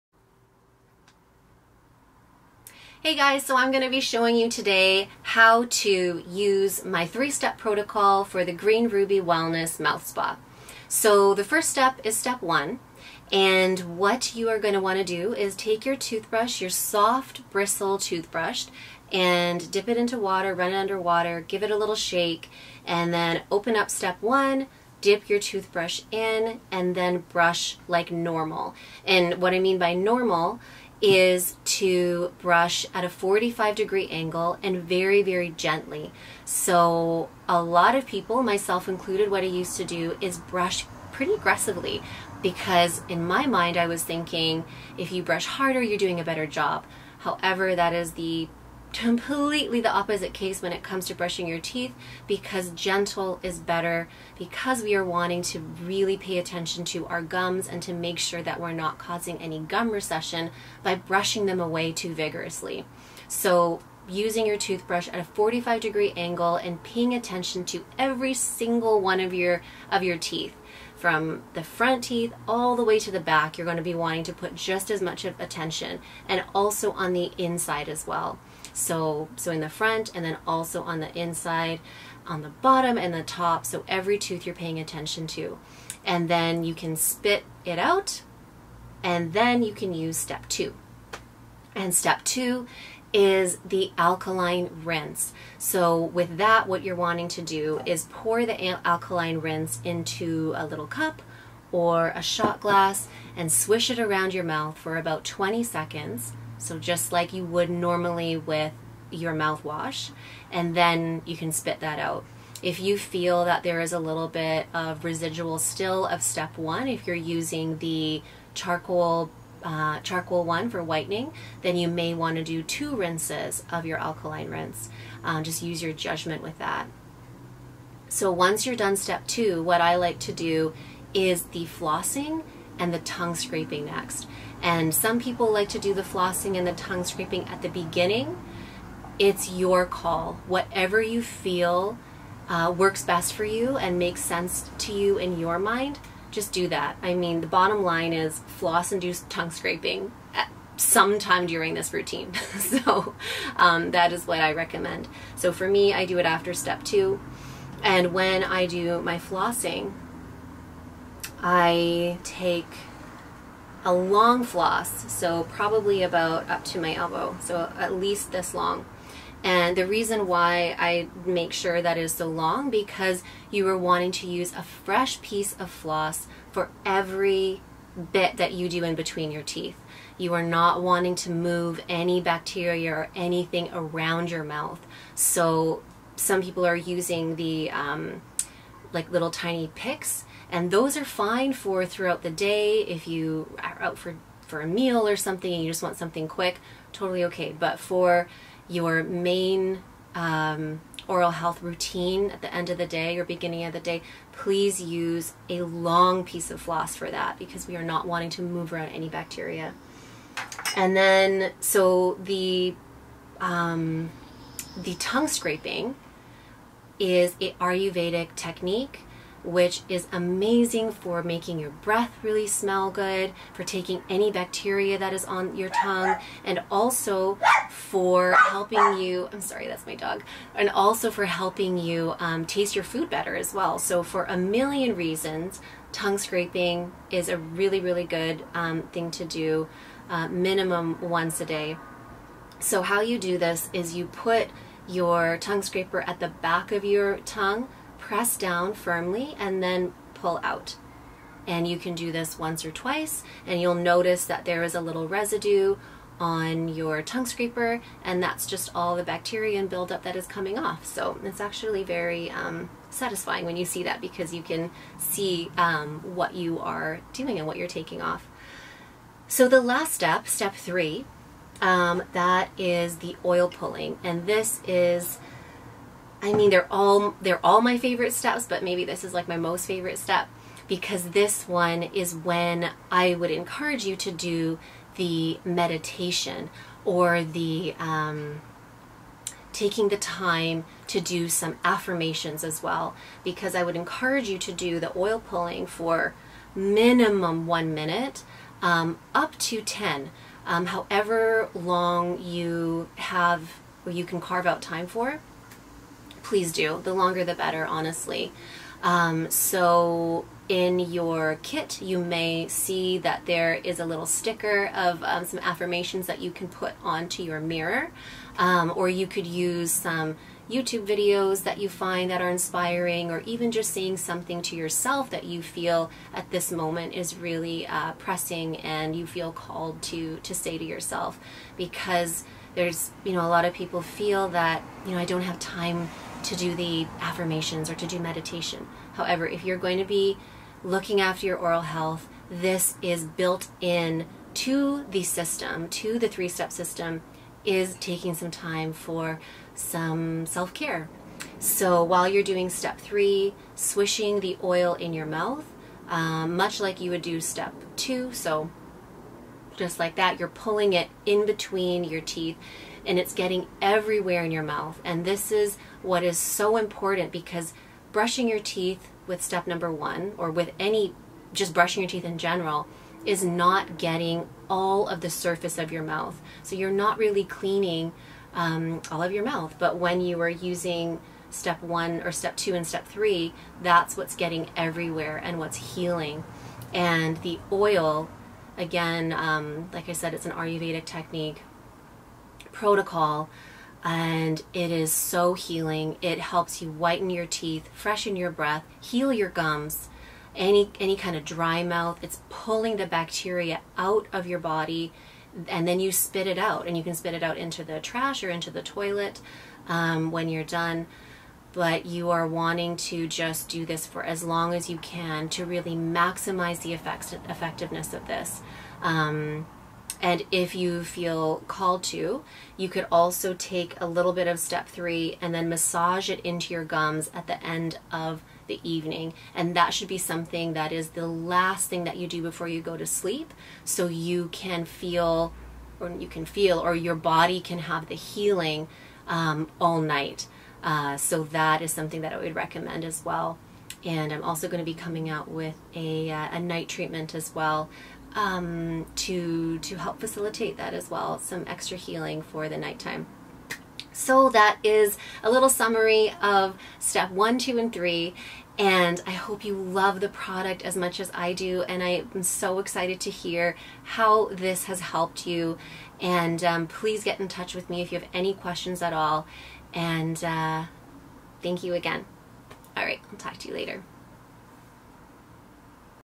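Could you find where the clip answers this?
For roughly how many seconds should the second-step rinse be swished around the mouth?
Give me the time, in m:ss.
1:45.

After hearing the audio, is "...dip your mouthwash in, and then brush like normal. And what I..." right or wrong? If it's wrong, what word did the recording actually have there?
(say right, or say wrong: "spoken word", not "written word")
wrong: "toothbrush", not "mouthwash".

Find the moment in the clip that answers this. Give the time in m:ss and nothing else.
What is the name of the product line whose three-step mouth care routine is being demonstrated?
0:08.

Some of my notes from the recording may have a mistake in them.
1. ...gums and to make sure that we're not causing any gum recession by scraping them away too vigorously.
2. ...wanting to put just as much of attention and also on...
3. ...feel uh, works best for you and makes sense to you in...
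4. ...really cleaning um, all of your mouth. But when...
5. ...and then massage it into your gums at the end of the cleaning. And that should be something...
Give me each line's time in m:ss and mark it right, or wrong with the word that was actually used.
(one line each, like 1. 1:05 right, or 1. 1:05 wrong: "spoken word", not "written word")
1. 0:57 wrong: "brushing", not "scraping"
2. 1:13 right
3. 2:21 right
4. 6:16 right
5. 7:05 wrong: "evening", not "cleaning".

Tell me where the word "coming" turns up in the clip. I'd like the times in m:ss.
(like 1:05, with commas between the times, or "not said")
4:20, 7:24.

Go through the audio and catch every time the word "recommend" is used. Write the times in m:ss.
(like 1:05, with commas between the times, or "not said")
2:34, 7:22.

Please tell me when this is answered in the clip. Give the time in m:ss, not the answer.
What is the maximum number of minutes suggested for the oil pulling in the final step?
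4:59.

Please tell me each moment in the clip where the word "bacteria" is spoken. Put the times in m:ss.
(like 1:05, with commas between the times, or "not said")
3:02, 3:29, 3:44, 4:19, 6:42.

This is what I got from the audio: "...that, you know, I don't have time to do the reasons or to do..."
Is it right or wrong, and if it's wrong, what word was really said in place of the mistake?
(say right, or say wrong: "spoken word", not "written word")
wrong: "affirmations", not "reasons".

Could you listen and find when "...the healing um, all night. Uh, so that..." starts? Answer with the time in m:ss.
7:17.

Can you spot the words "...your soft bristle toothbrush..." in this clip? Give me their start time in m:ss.
0:16.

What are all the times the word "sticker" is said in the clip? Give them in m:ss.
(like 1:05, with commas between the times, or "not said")
5:14.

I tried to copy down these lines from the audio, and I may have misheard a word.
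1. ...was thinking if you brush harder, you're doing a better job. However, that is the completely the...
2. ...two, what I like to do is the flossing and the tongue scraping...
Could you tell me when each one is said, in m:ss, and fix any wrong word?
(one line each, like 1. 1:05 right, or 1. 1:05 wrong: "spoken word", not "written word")
1. 0:43 right
2. 2:09 right.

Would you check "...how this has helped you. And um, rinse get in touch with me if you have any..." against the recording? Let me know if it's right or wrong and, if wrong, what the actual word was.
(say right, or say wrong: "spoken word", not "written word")
wrong: "please", not "rinse".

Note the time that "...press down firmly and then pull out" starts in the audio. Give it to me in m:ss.
4:08.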